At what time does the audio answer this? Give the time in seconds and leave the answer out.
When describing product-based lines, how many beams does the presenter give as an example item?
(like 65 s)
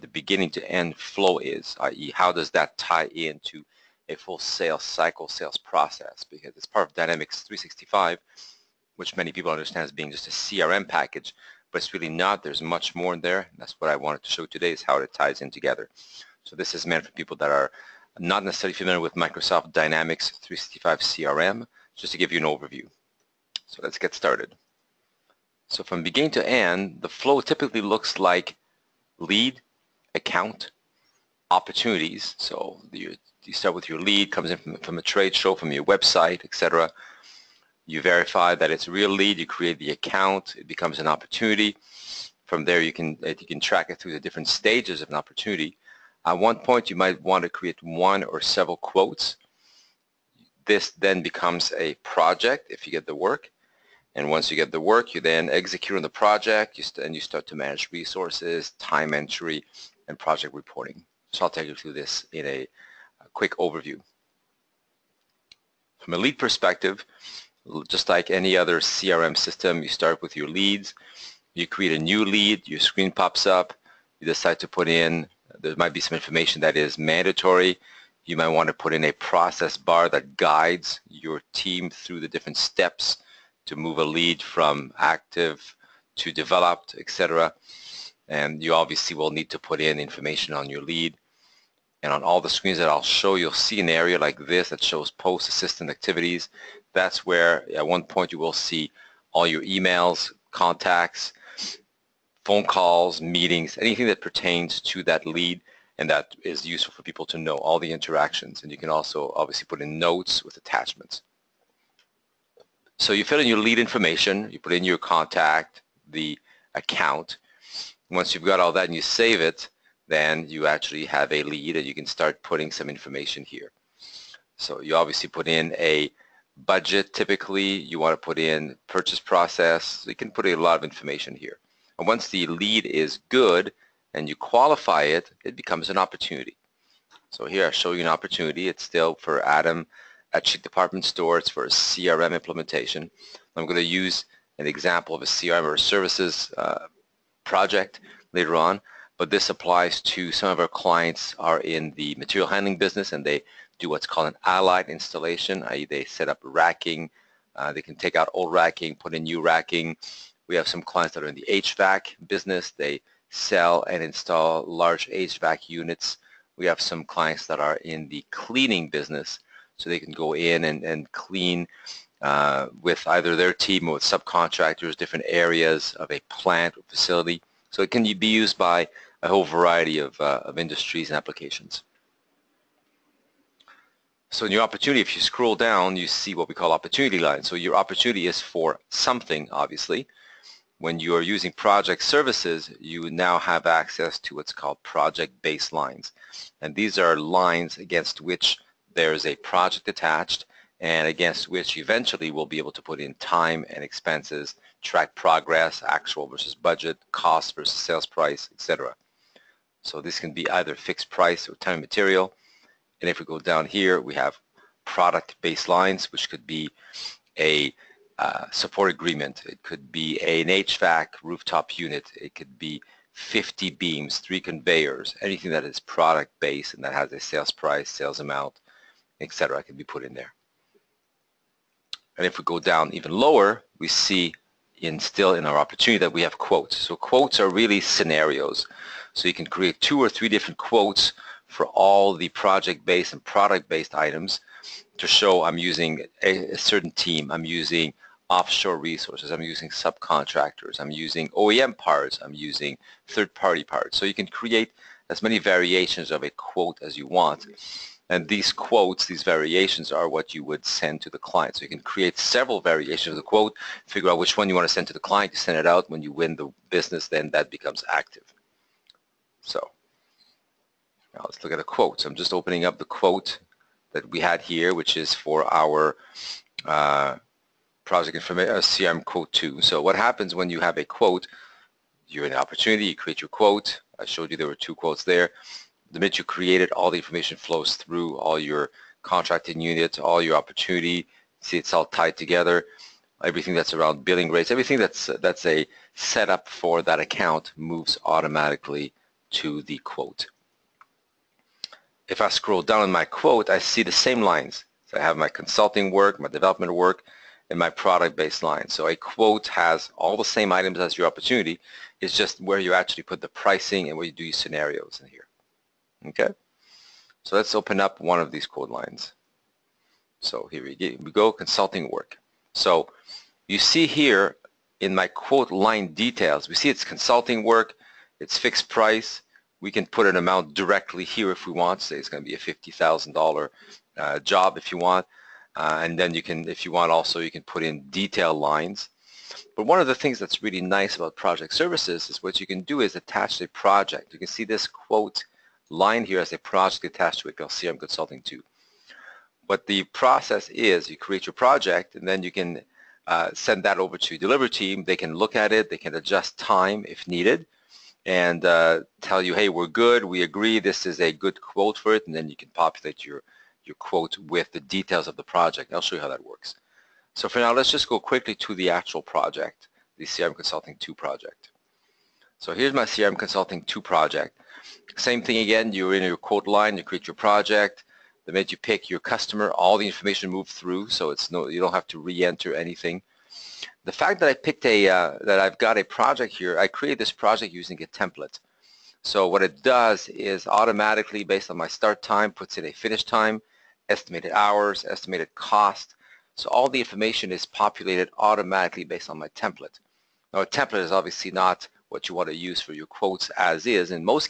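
223 s.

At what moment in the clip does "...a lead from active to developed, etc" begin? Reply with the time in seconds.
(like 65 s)
83 s.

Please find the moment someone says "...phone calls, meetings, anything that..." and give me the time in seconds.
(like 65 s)
102 s.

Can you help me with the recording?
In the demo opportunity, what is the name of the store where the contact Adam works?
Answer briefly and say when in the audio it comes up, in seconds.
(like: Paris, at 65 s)
Chic Department Store, at 140 s.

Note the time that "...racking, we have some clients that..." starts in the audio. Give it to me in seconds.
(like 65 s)
159 s.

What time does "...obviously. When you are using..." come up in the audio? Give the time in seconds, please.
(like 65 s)
189 s.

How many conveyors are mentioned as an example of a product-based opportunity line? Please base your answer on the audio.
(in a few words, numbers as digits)
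3.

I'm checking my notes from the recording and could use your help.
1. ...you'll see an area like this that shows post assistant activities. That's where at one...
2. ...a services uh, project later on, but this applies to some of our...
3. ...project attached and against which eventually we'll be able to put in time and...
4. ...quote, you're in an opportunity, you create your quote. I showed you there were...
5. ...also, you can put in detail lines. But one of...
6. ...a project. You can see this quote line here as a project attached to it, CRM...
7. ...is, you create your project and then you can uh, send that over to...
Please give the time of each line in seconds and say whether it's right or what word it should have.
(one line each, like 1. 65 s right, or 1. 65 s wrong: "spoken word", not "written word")
1. 93 s right
2. 145 s right
3. 199 s right
4. 280 s right
5. 336 s right
6. 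343 s right
7. 350 s right.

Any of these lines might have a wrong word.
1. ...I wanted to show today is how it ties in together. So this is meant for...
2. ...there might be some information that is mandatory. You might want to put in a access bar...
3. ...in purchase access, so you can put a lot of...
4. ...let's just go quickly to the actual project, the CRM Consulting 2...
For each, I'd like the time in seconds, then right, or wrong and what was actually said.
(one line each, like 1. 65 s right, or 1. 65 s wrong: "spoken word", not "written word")
1. 13 s right
2. 75 s wrong: "process", not "access"
3. 128 s wrong: "process", not "access"
4. 367 s right.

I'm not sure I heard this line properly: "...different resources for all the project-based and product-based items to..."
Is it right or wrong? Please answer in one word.
wrong.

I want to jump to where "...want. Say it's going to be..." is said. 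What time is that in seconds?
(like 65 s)
331 s.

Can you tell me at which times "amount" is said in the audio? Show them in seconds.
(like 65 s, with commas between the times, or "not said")
228 s, 330 s.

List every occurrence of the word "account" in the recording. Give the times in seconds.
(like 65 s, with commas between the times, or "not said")
30 s, 39 s, 116 s, 297 s.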